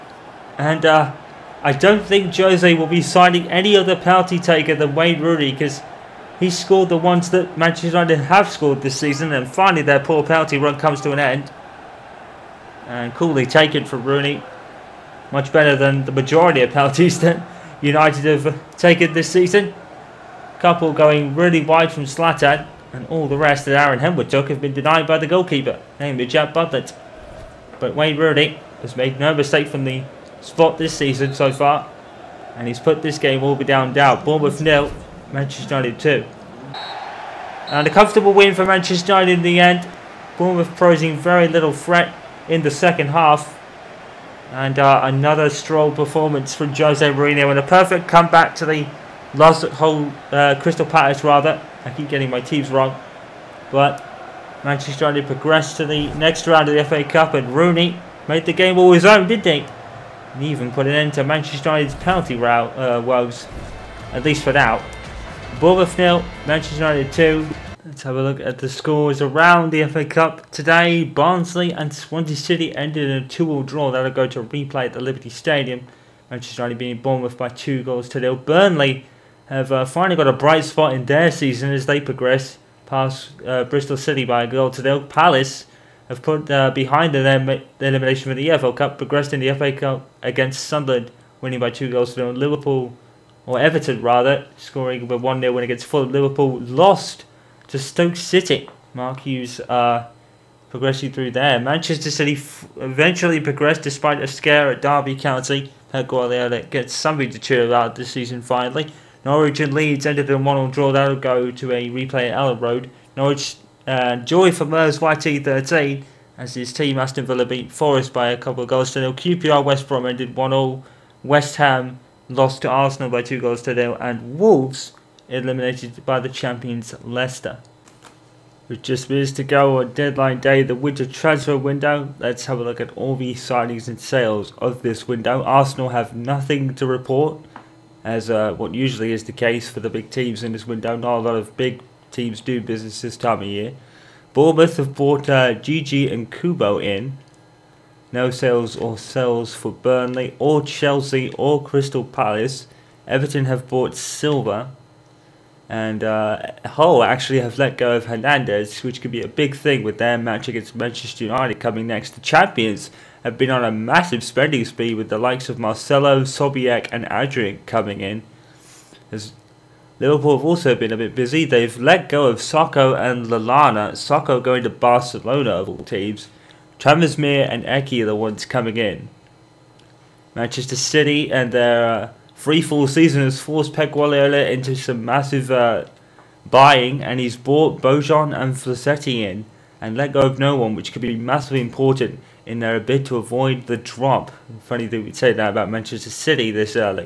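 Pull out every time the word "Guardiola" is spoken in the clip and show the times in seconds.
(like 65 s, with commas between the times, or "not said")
106 s, 183 s.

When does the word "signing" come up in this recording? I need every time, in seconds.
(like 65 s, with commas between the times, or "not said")
3 s, 133 s.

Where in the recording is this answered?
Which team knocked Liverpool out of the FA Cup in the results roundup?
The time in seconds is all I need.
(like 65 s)
97 s.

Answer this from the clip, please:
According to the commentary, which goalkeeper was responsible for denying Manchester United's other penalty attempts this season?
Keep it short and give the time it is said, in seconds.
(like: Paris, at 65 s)
Jack Butler, at 26 s.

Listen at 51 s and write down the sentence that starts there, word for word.
I keep getting my teams wrong.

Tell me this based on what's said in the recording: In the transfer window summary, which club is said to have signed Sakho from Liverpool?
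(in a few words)
Barcelona.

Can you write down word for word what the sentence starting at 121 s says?
West Ham lost to Arsenal by two goals to nil.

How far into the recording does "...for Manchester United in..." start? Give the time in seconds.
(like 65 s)
38 s.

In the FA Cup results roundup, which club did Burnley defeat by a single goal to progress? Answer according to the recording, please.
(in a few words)
Bristol City.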